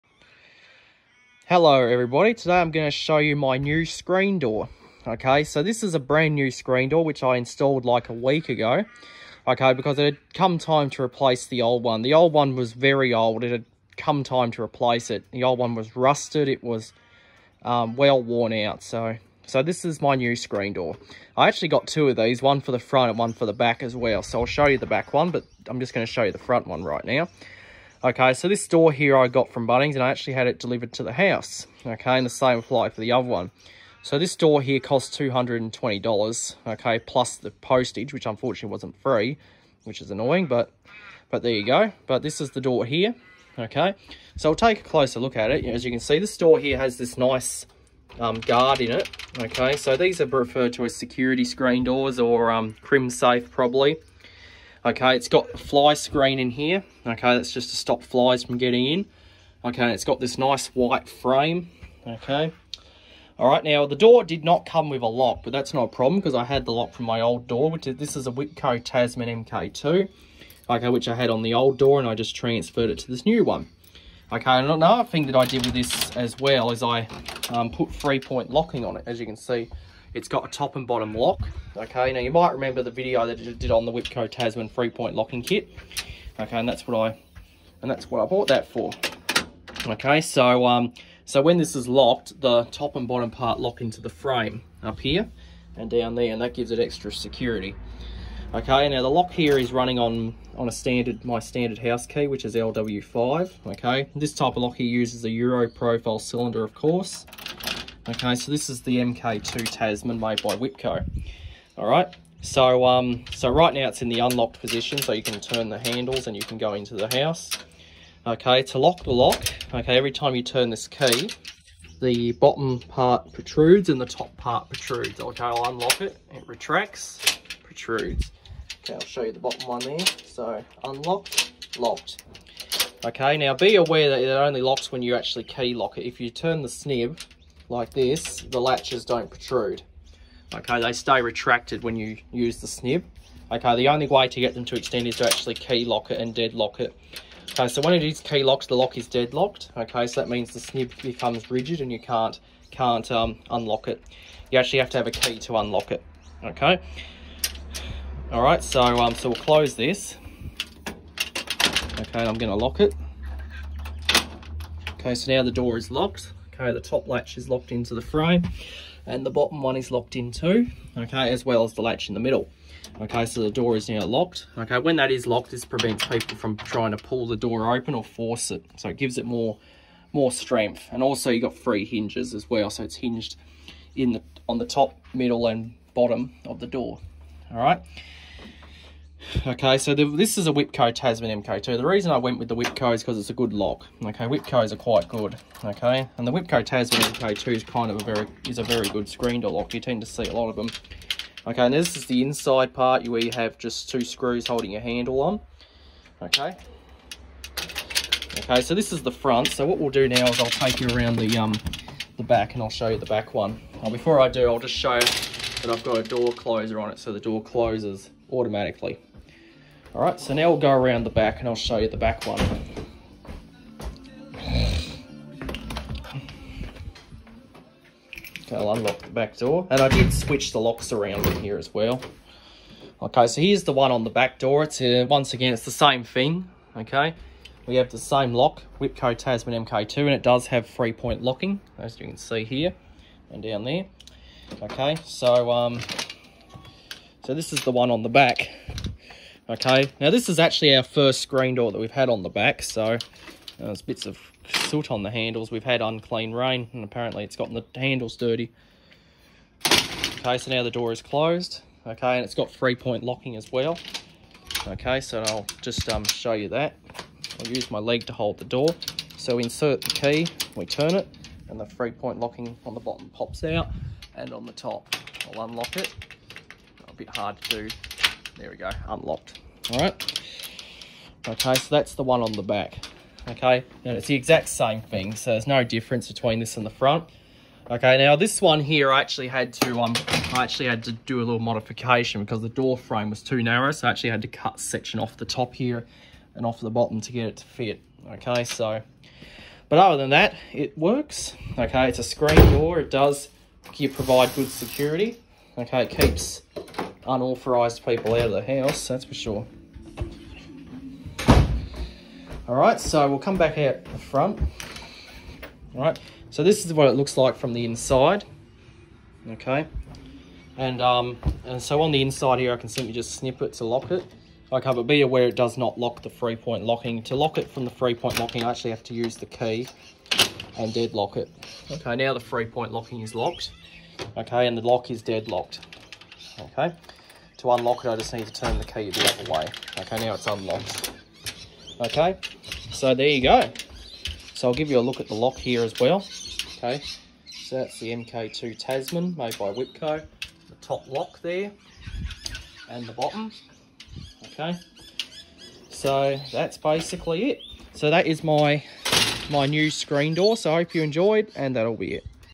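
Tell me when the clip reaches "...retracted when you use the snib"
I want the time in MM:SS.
02:21.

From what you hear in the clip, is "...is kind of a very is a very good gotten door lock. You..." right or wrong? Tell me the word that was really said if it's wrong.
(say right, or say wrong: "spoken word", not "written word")
wrong: "screen", not "gotten".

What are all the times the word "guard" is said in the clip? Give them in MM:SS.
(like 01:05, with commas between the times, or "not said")
00:48.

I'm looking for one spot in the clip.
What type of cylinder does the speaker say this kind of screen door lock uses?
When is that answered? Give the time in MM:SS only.
01:45.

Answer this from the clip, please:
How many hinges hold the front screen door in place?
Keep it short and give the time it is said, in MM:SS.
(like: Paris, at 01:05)
3, at 03:01.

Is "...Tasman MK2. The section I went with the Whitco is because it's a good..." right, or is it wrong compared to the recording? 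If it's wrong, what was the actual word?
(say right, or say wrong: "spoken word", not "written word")
wrong: "reason", not "section".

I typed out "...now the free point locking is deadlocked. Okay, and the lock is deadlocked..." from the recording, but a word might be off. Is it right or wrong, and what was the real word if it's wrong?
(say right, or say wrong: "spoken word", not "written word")
wrong: "locked", not "deadlocked".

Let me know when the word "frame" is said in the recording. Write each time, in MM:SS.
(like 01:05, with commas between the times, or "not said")
01:01, 01:34, 02:48, 04:52.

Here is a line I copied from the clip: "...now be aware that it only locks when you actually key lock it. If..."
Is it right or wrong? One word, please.
right.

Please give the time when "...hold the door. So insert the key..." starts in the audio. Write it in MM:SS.
04:28.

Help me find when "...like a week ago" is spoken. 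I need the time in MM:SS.
00:07.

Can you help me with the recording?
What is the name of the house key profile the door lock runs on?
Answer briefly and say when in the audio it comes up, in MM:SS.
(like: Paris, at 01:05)
LW5, at 01:42.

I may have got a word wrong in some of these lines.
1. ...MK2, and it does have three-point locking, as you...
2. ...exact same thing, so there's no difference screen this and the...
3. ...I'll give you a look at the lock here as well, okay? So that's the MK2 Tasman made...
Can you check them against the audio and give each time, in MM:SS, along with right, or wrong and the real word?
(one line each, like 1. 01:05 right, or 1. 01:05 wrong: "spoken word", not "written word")
1. 03:59 right
2. 04:44 wrong: "between", not "screen"
3. 05:44 right.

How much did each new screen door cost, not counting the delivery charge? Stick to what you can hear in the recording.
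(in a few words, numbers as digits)
$220.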